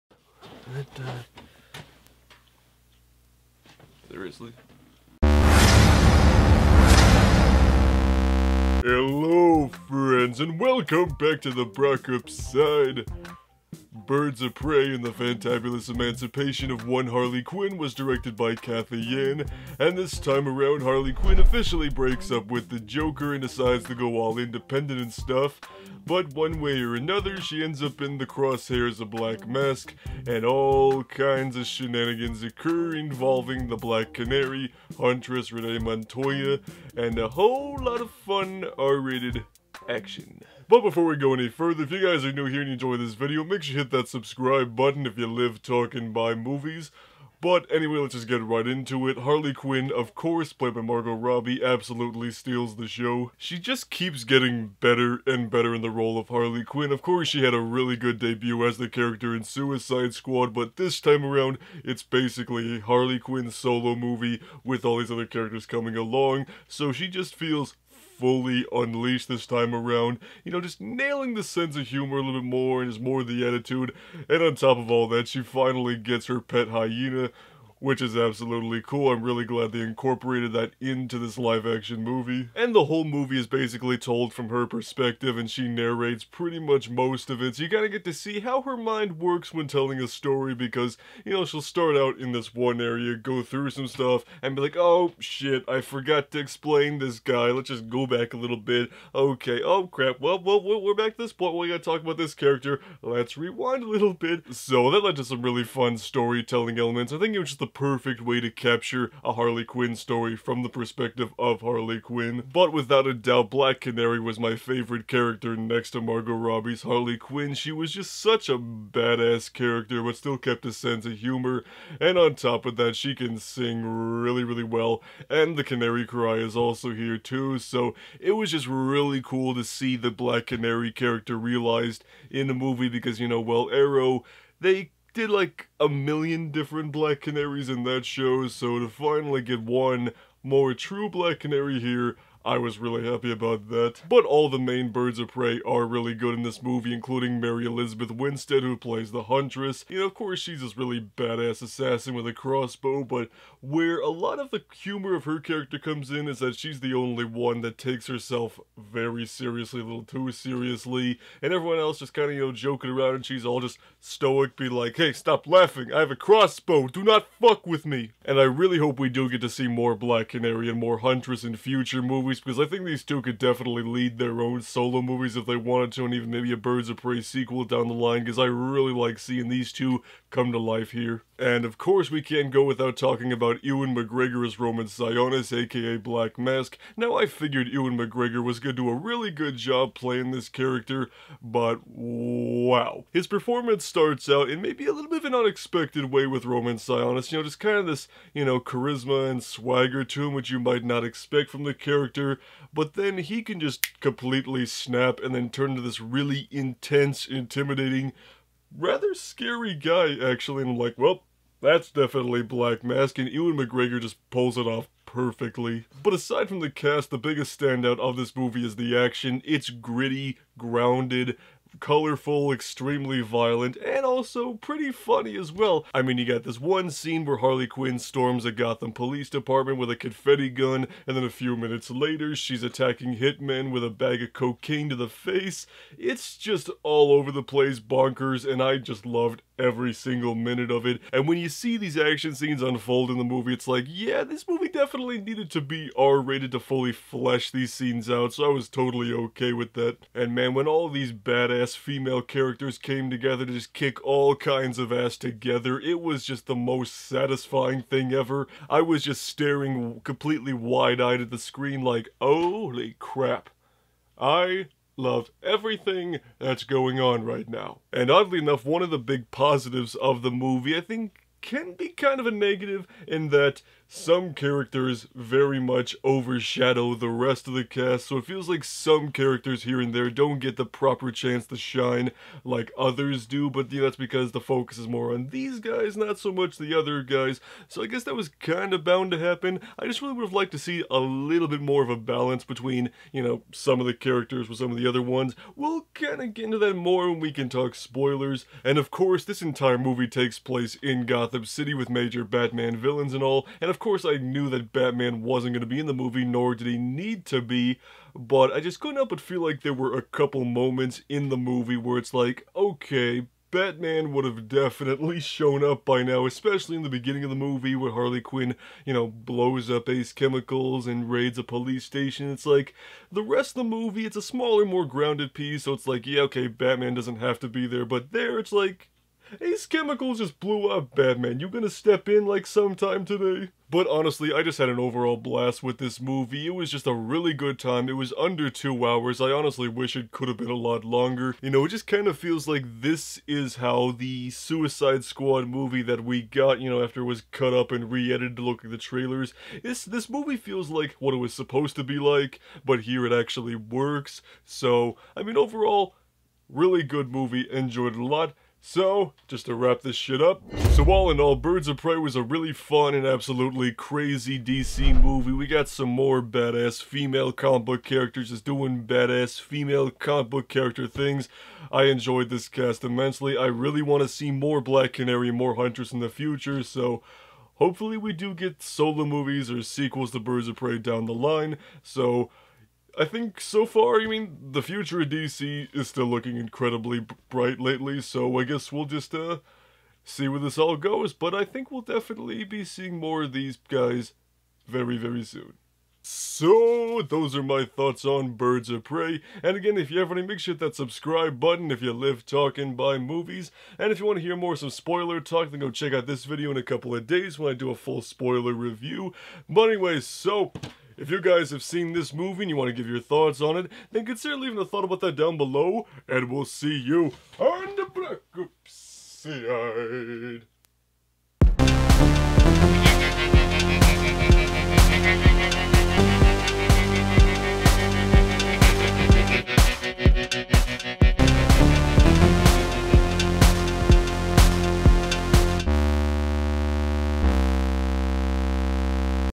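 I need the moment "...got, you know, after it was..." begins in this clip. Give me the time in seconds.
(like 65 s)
346 s.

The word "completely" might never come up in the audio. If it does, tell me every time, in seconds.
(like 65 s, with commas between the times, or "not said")
203 s, 260 s.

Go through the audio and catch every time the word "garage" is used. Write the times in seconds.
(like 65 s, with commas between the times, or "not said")
not said.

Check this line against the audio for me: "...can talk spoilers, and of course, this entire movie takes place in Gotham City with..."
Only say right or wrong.
right.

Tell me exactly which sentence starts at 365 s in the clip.
We got some more badass female comic book characters just doing badass female comic book character things.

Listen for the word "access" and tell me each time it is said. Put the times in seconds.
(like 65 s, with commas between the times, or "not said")
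not said.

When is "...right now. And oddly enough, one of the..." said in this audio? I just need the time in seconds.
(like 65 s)
267 s.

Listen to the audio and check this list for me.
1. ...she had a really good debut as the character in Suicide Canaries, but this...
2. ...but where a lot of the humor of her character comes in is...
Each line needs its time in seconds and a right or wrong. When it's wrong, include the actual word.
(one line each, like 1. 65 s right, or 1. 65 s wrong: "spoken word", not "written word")
1. 57 s wrong: "Squad", not "Canaries"
2. 153 s right.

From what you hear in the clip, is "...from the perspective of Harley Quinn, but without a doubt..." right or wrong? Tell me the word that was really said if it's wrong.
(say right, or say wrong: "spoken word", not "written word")
right.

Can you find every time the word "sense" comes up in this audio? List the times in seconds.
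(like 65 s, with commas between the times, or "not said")
71 s, 120 s.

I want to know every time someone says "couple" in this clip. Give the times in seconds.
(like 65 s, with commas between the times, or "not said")
310 s, 406 s.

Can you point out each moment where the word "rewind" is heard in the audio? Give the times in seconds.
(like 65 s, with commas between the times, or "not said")
103 s.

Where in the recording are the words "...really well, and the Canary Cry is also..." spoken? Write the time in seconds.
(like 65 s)
124 s.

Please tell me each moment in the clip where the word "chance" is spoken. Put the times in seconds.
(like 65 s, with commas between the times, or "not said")
281 s.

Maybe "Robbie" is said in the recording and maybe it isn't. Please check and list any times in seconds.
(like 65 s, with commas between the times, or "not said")
51 s, 116 s.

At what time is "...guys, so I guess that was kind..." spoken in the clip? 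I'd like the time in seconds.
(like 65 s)
287 s.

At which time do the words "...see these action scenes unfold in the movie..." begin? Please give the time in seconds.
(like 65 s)
241 s.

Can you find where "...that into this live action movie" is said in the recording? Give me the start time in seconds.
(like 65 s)
80 s.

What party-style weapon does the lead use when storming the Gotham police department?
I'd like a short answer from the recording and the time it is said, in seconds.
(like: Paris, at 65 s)
Confetti gun, at 229 s.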